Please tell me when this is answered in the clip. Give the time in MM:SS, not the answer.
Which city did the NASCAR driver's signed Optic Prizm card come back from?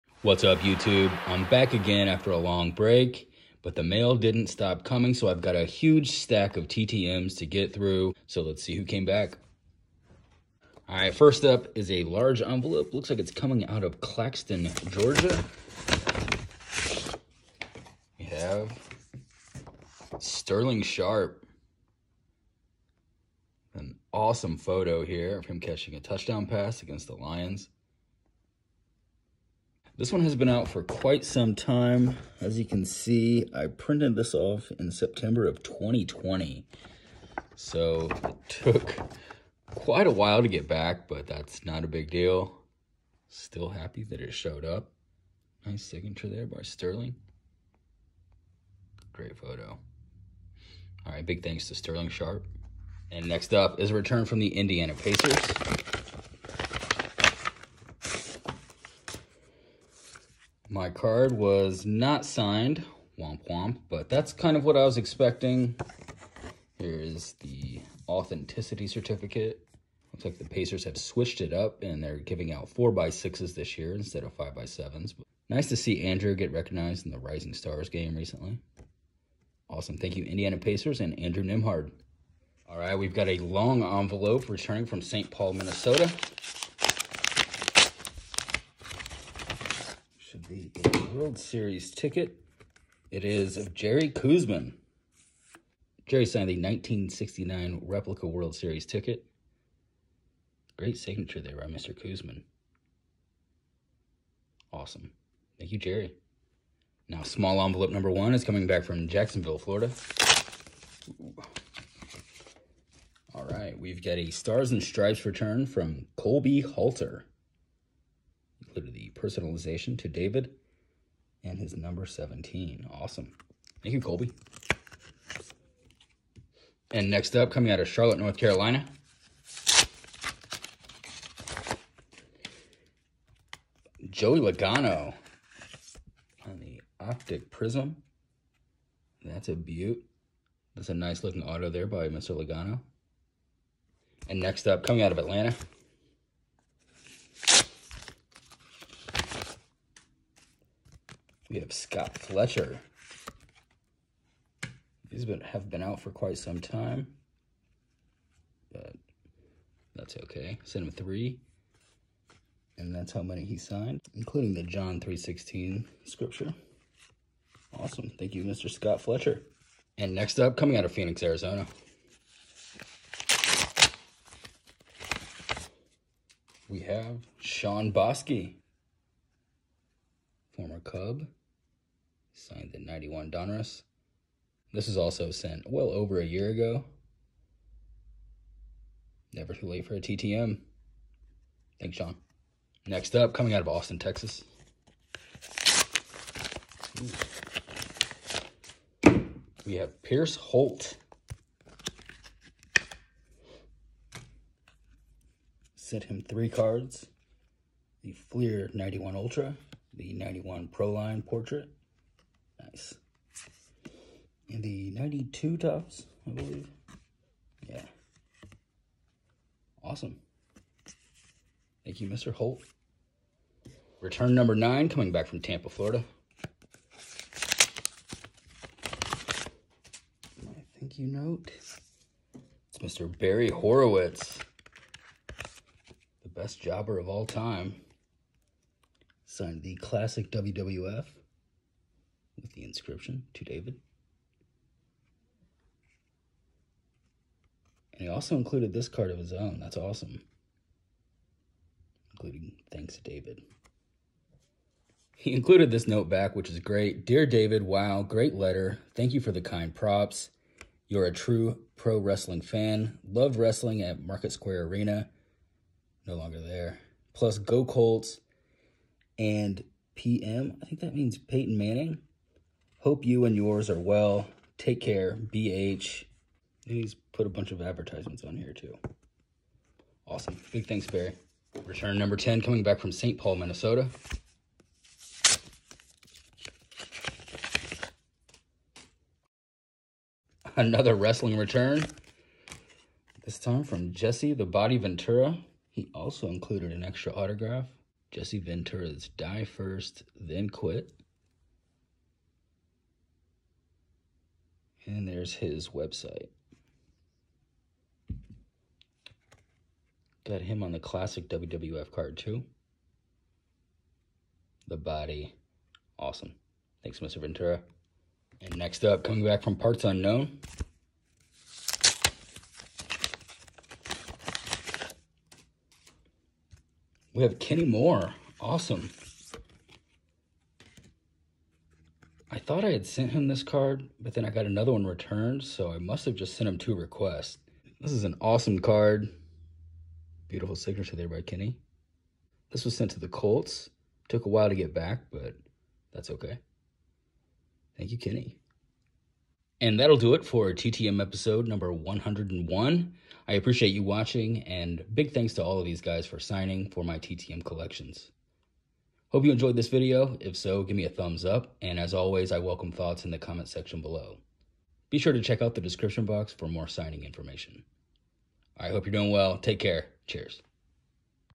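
02:07.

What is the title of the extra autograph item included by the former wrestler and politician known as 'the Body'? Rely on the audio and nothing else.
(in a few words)
Die First, Then Quit.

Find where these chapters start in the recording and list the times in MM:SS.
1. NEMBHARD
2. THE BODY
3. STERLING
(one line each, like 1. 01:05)
1. 00:55
2. 04:44
3. 00:11.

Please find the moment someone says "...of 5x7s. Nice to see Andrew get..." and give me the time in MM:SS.
01:14.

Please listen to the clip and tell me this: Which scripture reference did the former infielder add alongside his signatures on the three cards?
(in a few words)
John 3.16.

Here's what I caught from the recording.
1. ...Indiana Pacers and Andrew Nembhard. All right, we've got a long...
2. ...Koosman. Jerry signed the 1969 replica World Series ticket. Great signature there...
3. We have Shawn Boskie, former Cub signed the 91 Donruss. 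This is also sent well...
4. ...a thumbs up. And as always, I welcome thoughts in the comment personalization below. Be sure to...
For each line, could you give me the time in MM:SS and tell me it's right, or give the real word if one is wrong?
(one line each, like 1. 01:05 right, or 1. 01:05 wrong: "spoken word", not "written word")
1. 01:20 right
2. 01:34 right
3. 02:56 right
4. 06:00 wrong: "section", not "personalization".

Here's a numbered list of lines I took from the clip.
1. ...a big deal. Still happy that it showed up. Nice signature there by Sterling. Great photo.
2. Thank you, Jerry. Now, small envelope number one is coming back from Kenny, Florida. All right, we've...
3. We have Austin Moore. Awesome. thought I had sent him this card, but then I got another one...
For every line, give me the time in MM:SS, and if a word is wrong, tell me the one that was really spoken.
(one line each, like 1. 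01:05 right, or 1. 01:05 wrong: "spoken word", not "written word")
1. 00:41 right
2. 01:45 wrong: "Jacksonville", not "Kenny"
3. 05:27 wrong: "Kenny", not "Austin".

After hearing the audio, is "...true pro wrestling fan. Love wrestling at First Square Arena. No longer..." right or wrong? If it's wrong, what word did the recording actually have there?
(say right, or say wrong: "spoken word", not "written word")
wrong: "Market", not "First".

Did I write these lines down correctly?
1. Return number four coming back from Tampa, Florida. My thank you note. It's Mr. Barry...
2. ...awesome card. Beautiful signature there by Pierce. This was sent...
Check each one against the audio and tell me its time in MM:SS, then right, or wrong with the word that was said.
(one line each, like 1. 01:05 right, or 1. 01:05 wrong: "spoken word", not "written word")
1. 03:44 wrong: "nine", not "four"
2. 05:38 wrong: "Kenny", not "Pierce".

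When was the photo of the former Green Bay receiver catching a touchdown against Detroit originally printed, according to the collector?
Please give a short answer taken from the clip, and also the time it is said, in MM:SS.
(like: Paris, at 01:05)
September of 2020, at 00:34.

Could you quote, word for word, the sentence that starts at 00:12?
Looks like it's coming out of Claxton, Georgia.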